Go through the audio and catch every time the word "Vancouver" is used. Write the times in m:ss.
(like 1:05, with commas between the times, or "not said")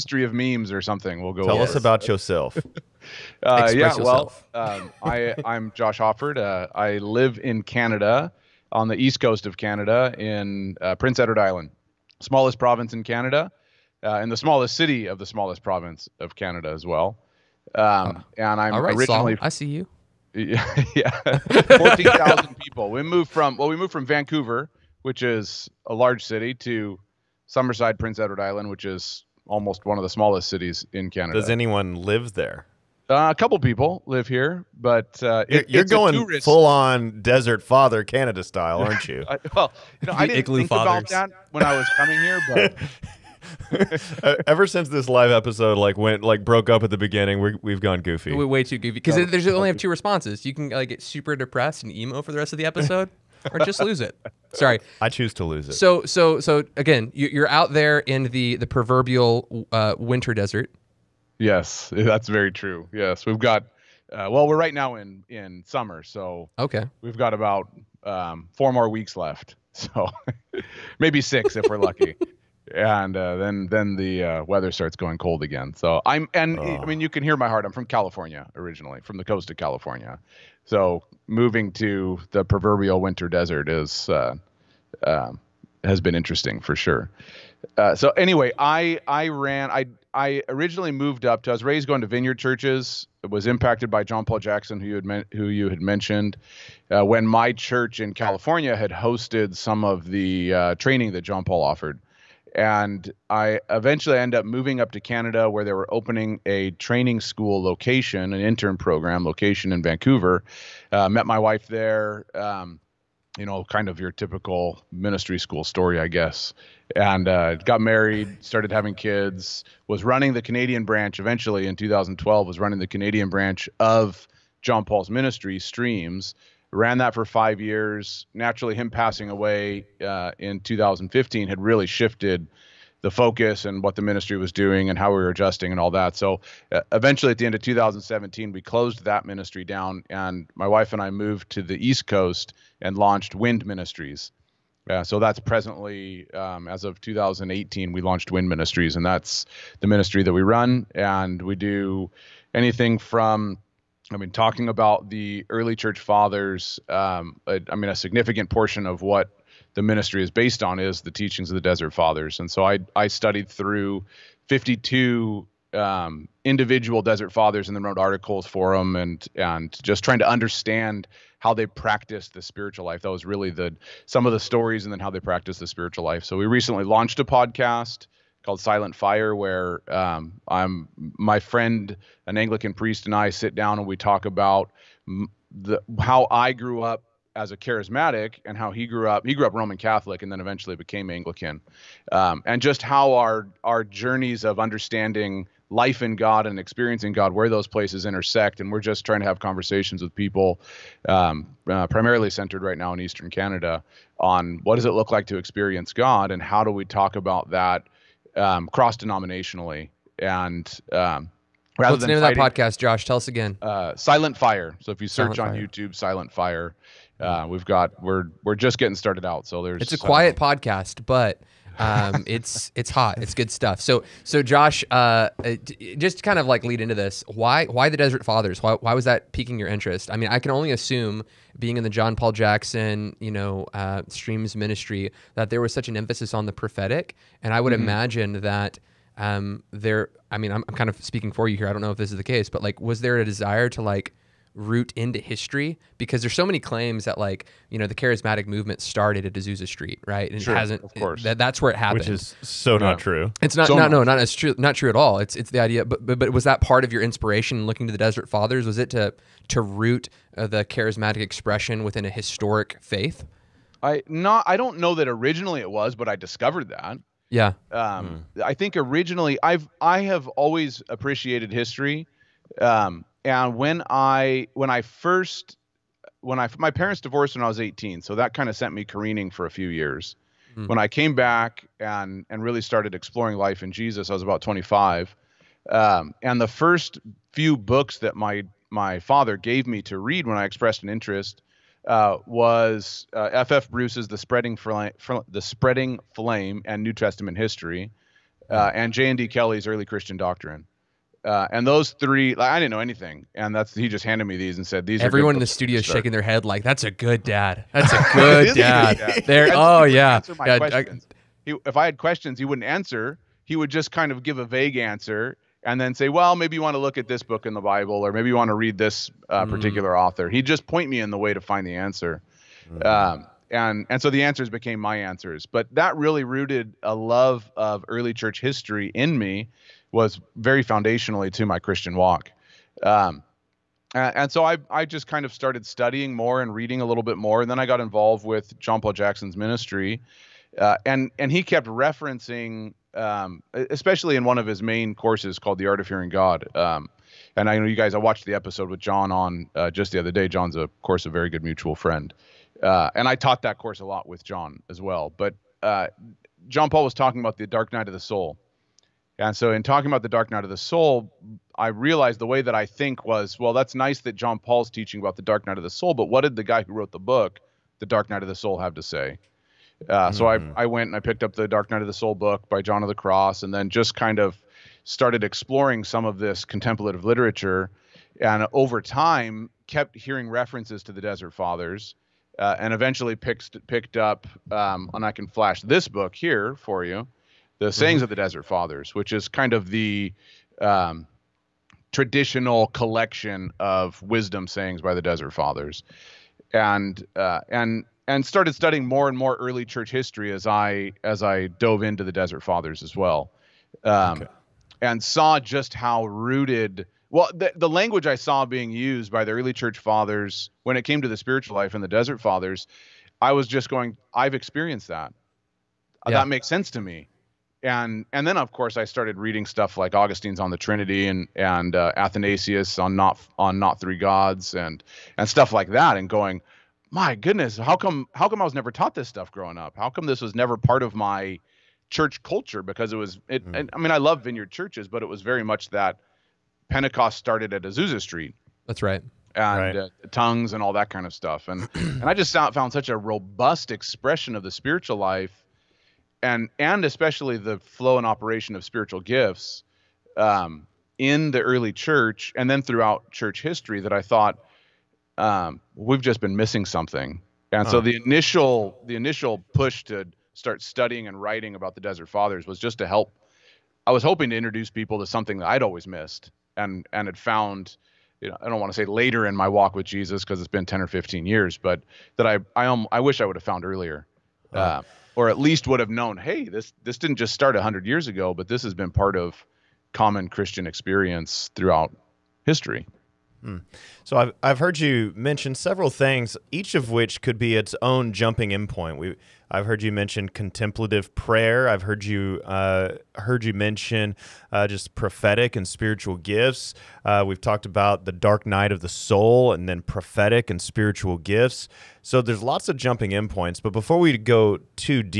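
0:24, 1:49.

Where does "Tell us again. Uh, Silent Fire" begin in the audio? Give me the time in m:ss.
3:33.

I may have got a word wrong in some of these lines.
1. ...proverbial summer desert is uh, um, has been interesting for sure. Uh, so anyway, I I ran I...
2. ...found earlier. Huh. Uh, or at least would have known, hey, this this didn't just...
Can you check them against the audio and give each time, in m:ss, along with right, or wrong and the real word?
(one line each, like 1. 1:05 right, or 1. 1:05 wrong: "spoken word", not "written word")
1. 1:22 wrong: "winter", not "summer"
2. 7:53 right.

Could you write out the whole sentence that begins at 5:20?
He'd just point me in the way to find the answer.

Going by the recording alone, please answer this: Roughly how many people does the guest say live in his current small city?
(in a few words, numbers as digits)
14,000.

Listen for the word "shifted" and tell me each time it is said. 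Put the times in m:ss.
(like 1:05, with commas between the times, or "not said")
2:11.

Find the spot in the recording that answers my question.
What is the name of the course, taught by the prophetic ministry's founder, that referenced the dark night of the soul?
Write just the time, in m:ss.
5:45.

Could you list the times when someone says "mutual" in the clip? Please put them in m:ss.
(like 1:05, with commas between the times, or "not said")
5:51.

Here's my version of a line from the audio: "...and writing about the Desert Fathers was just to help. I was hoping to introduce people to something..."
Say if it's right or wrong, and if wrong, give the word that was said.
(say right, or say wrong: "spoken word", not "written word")
right.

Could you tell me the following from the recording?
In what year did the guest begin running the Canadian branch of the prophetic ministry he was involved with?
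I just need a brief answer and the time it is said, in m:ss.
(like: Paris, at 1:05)
2012, at 2:01.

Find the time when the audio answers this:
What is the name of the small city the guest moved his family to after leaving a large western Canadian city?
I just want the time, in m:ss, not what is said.
0:27.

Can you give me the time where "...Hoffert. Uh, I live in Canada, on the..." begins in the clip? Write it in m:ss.
0:05.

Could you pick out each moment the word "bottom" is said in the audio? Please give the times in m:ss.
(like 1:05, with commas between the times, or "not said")
not said.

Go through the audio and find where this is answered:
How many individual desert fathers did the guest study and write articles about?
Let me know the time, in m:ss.
2:44.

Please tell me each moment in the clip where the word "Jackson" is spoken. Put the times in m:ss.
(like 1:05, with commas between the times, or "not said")
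1:34, 3:52, 5:38.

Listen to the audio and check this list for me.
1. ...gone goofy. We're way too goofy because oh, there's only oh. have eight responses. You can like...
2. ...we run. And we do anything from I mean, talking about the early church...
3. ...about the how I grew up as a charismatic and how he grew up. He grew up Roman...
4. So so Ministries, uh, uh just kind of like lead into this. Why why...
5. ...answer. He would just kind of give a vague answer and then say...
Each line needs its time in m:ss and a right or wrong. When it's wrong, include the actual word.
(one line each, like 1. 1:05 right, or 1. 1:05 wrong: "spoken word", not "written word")
1. 0:47 wrong: "two", not "eight"
2. 2:30 right
3. 3:04 right
4. 3:43 wrong: "Josh", not "Ministries"
5. 5:12 right.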